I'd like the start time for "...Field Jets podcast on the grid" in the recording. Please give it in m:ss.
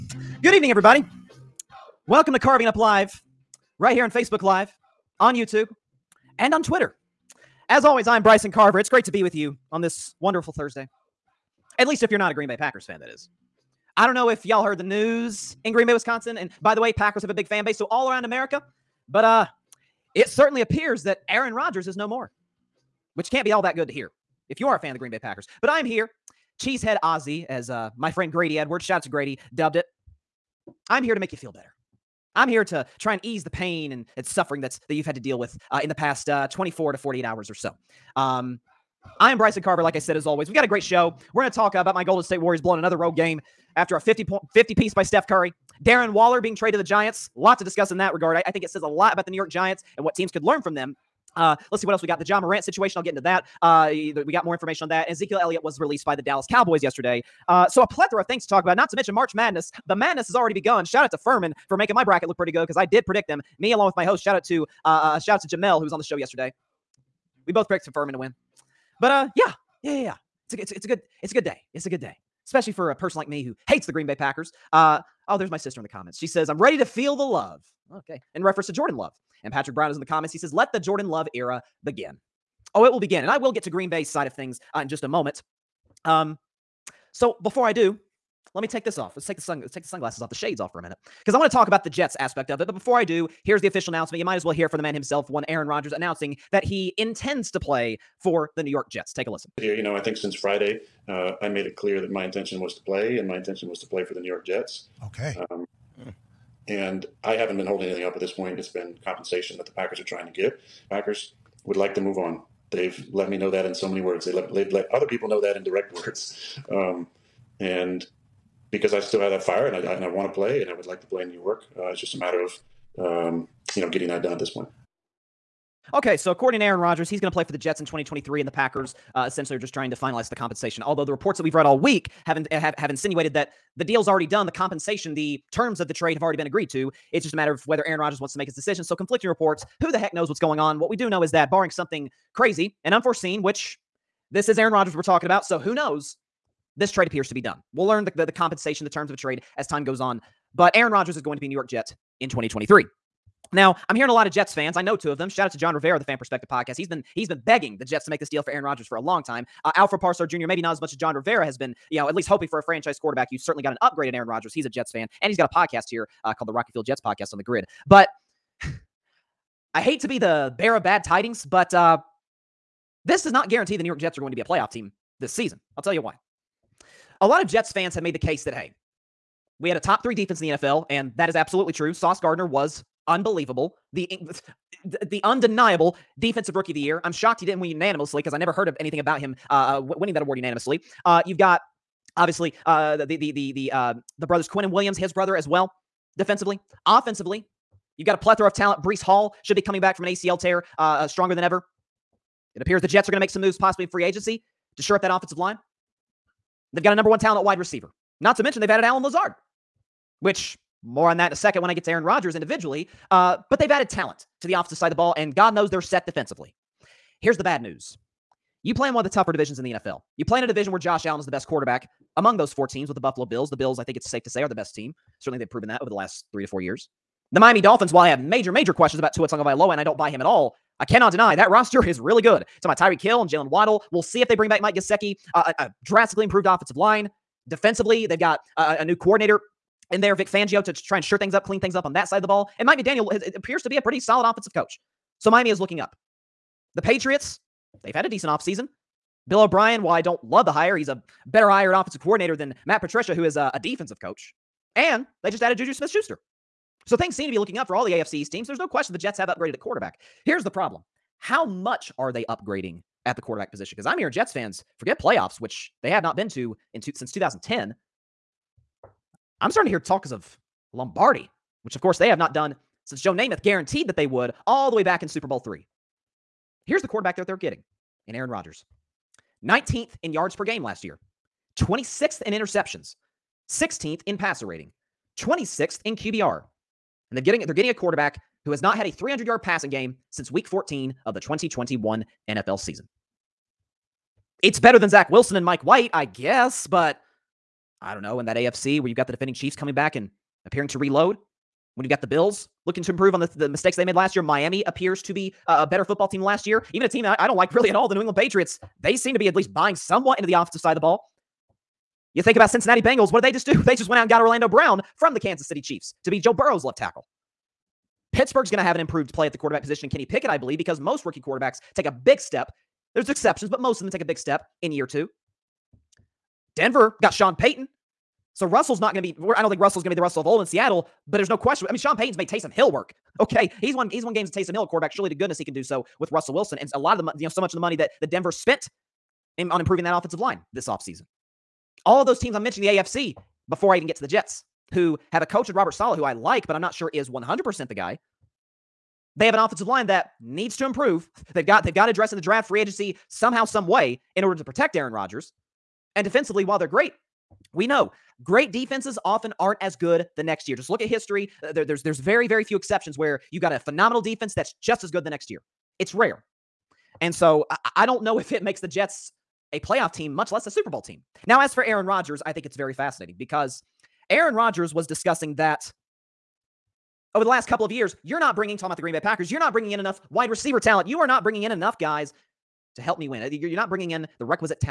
2:46.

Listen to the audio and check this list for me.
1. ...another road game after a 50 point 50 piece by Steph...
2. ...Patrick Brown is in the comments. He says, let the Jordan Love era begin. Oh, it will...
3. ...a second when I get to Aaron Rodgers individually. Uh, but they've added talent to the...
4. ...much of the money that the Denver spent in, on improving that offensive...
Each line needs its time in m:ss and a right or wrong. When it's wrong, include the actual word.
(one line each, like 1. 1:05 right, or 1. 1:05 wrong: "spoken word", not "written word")
1. 0:42 right
2. 1:19 right
3. 3:31 right
4. 5:37 right.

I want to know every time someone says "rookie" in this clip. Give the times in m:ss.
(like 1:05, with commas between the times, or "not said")
3:06, 5:21.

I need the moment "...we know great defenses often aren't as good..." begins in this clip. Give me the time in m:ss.
5:57.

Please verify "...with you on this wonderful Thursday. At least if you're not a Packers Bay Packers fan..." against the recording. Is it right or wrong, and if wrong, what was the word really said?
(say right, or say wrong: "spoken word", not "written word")
wrong: "Green", not "Packers".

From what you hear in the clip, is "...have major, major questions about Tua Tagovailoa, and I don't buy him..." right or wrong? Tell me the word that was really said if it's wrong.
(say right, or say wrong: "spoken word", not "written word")
right.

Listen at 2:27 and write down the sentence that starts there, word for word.
We'll learn the, the, the compensation, the terms of a trade as time goes on.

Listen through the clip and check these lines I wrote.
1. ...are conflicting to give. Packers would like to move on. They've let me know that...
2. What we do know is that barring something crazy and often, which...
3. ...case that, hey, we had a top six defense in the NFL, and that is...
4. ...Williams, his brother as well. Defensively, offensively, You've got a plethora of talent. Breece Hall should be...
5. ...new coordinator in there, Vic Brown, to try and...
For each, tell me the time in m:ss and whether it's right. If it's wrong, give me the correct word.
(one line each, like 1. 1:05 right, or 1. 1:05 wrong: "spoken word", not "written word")
1. 1:49 wrong: "trying", not "conflicting"
2. 2:20 wrong: "unforeseen", not "often"
3. 2:58 wrong: "three", not "six"
4. 3:14 right
5. 3:58 wrong: "Fangio", not "Brown".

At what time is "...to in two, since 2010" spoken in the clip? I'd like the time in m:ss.
4:26.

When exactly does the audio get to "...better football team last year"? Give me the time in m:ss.
5:05.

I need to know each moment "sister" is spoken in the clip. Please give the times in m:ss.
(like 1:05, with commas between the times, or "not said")
1:15.